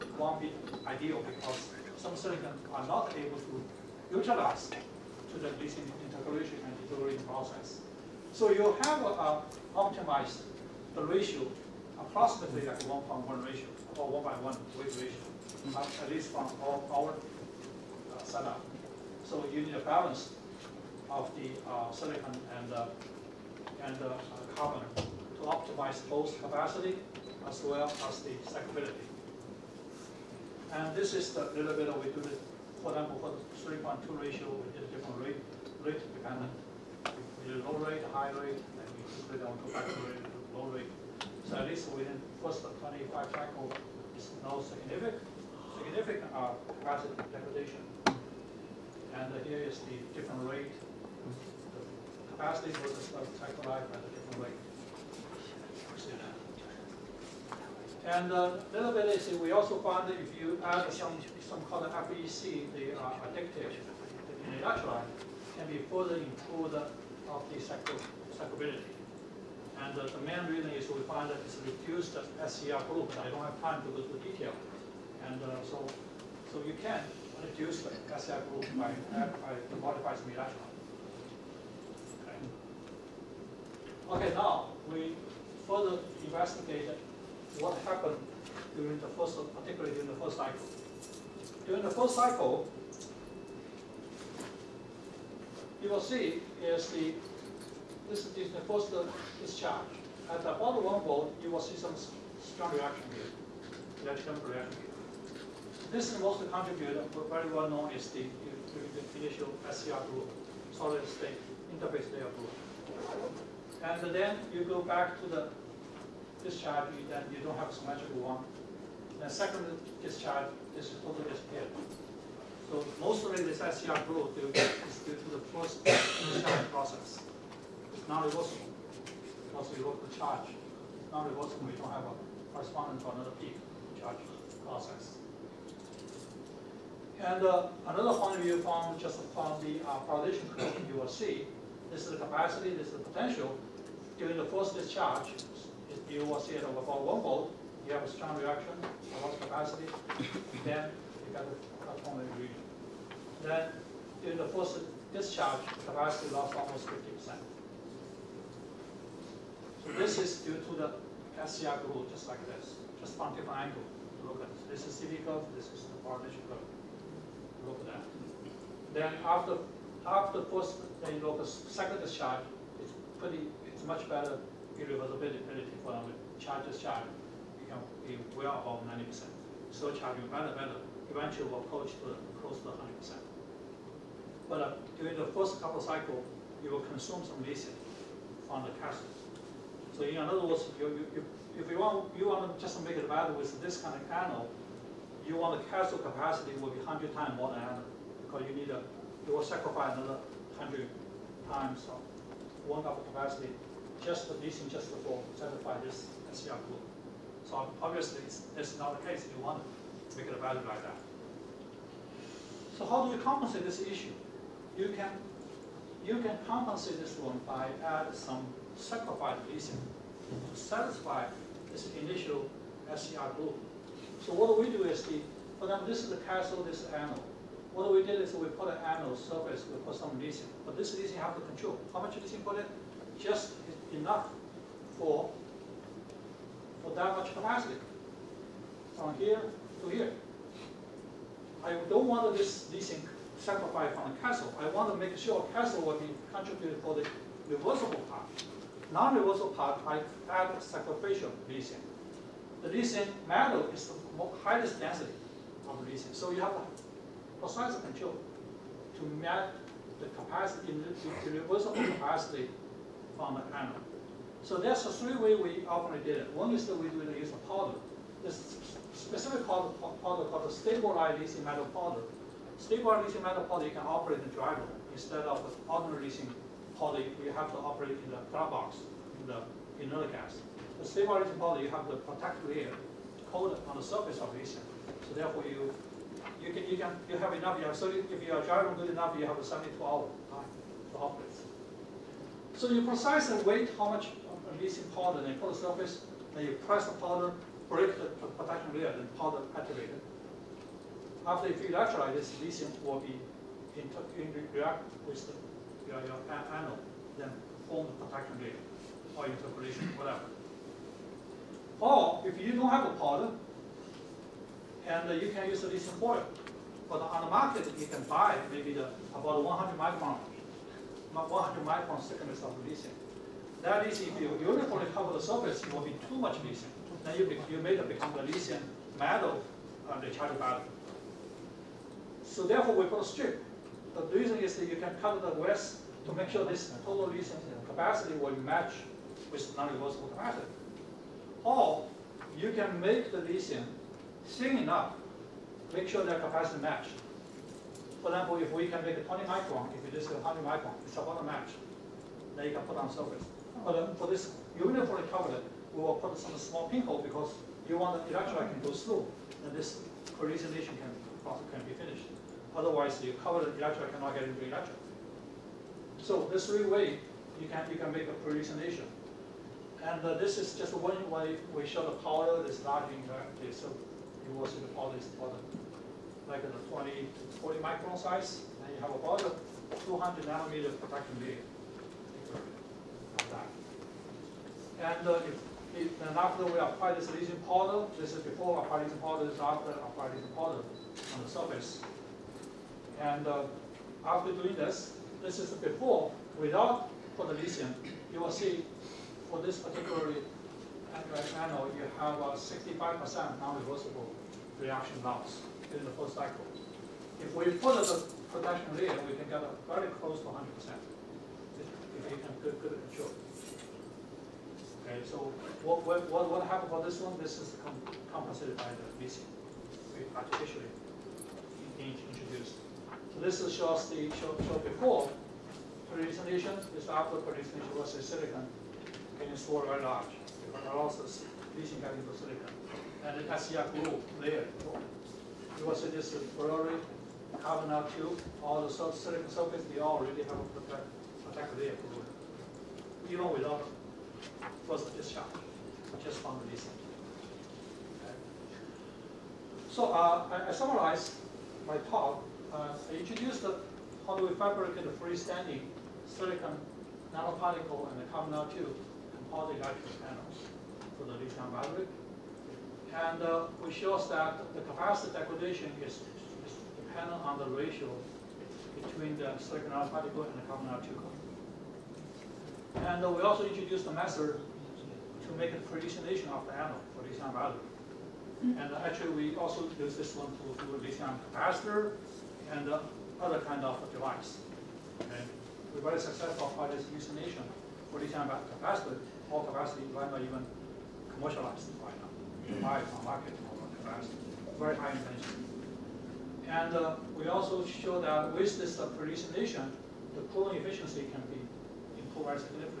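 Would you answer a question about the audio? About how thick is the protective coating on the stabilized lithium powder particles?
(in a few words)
200 nanometers.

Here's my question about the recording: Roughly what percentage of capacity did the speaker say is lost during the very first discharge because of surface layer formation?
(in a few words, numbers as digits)
50%.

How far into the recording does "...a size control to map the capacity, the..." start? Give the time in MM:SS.
04:17.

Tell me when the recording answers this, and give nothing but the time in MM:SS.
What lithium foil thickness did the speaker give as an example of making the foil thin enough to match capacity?
05:49.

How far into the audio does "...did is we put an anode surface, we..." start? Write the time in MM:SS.
03:48.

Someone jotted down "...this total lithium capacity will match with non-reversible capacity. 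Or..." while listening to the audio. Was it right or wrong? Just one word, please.
right.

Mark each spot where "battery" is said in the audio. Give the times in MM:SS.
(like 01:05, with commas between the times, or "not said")
05:30, 07:41, 07:57.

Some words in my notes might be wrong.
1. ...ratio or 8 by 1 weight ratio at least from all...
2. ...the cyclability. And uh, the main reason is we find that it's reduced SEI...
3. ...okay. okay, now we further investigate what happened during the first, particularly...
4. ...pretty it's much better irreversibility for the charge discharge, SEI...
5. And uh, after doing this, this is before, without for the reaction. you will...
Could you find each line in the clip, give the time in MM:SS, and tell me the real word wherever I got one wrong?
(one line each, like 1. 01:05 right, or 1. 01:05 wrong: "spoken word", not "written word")
1. 00:13 wrong: "1", not "8"
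2. 01:07 right
3. 01:20 right
4. 02:53 wrong: "You", not "SEI"
5. 06:33 wrong: "lesion", not "reaction".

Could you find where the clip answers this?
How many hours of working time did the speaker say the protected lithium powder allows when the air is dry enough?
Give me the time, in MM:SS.
04:49.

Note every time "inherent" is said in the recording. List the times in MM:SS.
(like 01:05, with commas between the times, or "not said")
not said.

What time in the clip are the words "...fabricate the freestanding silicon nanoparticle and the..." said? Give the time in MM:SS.
07:34.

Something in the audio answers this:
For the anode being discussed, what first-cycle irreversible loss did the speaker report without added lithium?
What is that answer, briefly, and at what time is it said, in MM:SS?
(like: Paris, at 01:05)
65%, at 06:43.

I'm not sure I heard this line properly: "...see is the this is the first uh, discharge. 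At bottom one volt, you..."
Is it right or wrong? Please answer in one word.
right.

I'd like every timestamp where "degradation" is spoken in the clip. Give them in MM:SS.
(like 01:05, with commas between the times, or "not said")
00:47, 07:45.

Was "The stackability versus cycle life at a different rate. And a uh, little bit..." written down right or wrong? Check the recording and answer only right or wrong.
wrong.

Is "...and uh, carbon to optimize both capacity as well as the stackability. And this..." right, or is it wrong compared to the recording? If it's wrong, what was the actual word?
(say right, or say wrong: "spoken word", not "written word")
right.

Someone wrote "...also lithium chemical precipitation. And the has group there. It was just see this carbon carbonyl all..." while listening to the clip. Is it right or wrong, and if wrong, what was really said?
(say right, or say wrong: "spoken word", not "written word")
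wrong: "silicon", not "precipitation".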